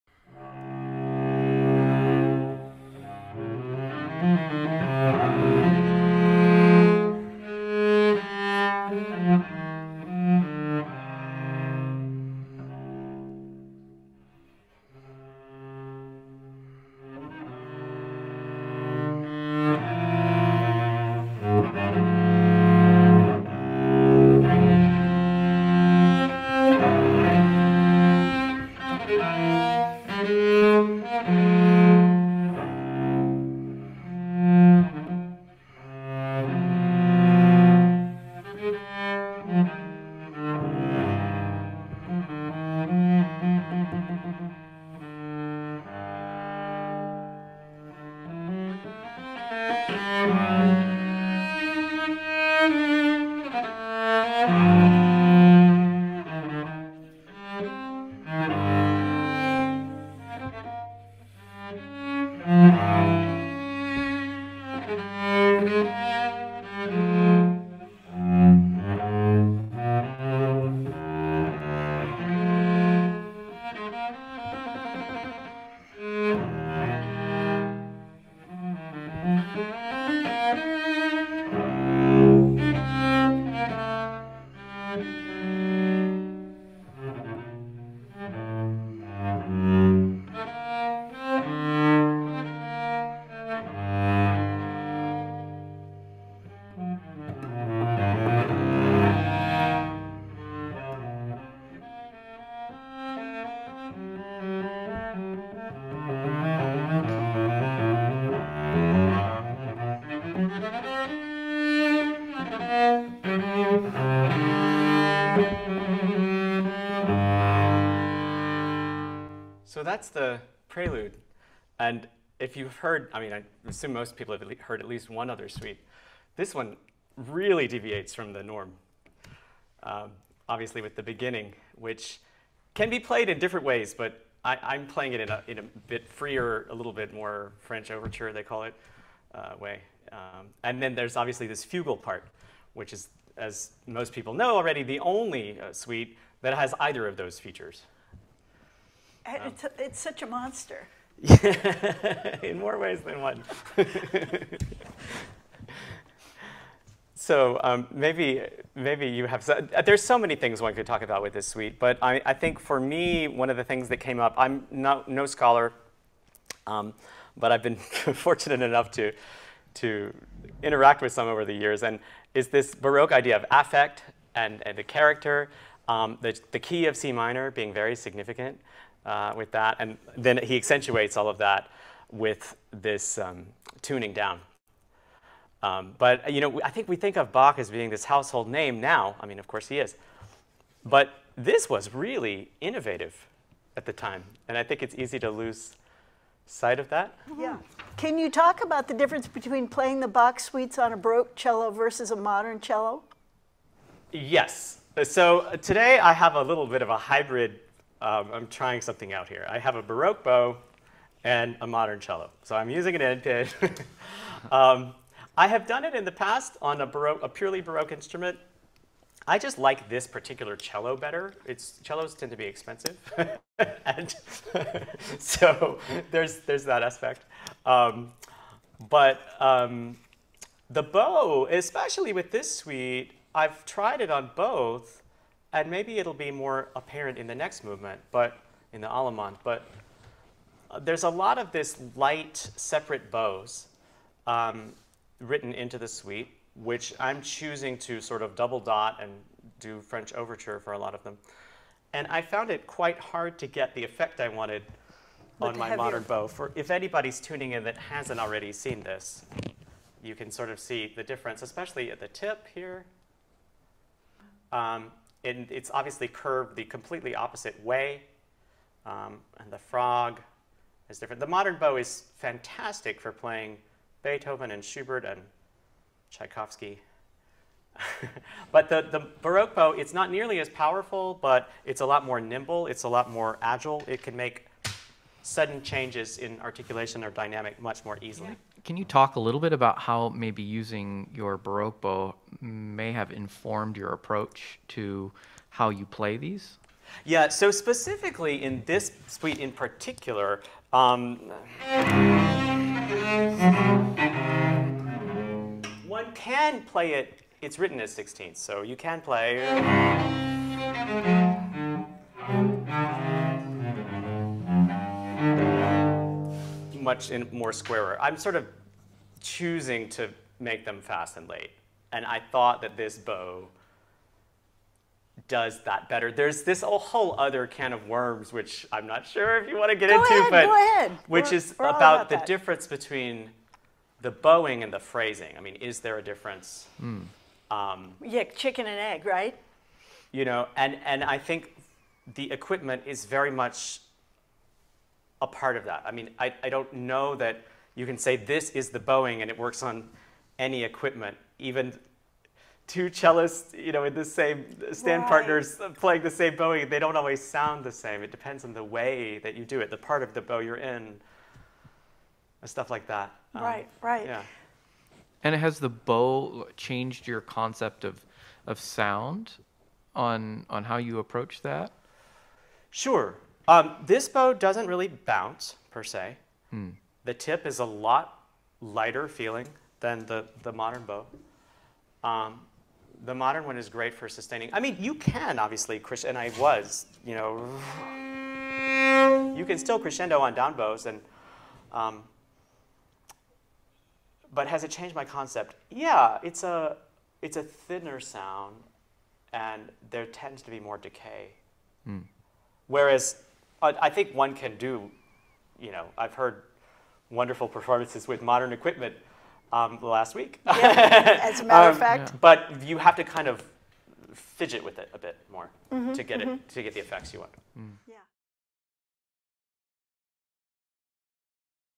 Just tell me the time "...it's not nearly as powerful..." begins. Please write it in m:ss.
4:39.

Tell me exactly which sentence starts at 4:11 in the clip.
And I found it quite hard to get the effect I wanted on my modern bow.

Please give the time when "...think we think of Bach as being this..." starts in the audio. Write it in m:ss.
3:06.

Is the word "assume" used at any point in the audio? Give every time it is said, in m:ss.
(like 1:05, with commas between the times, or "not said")
2:03.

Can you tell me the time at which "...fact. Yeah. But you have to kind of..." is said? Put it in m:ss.
6:51.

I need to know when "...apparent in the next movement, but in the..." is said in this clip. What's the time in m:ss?
3:56.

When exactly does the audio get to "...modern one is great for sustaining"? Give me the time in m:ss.
6:23.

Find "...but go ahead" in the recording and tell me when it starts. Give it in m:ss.
5:30.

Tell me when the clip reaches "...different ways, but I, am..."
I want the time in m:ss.
2:13.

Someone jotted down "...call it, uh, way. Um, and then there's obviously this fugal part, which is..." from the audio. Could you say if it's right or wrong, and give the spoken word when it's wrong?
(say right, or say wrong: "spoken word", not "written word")
right.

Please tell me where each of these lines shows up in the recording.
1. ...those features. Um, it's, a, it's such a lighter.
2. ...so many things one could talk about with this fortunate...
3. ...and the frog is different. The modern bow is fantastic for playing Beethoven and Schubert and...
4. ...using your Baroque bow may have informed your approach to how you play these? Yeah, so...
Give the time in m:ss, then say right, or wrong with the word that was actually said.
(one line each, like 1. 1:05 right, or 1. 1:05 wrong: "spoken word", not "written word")
1. 2:27 wrong: "monster", not "lighter"
2. 2:40 wrong: "suite", not "fortunate"
3. 4:29 right
4. 4:50 right.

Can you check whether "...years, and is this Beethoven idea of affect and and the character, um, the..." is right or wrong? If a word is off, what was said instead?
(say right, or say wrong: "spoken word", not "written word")
wrong: "Baroque", not "Beethoven".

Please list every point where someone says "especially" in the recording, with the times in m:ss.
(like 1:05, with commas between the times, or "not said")
3:51, 4:21.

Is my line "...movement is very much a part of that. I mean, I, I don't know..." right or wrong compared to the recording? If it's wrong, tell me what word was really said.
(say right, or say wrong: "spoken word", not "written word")
wrong: "equipment", not "movement".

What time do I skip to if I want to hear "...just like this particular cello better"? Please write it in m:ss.
3:39.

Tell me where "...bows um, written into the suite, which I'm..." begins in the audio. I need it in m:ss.
4:03.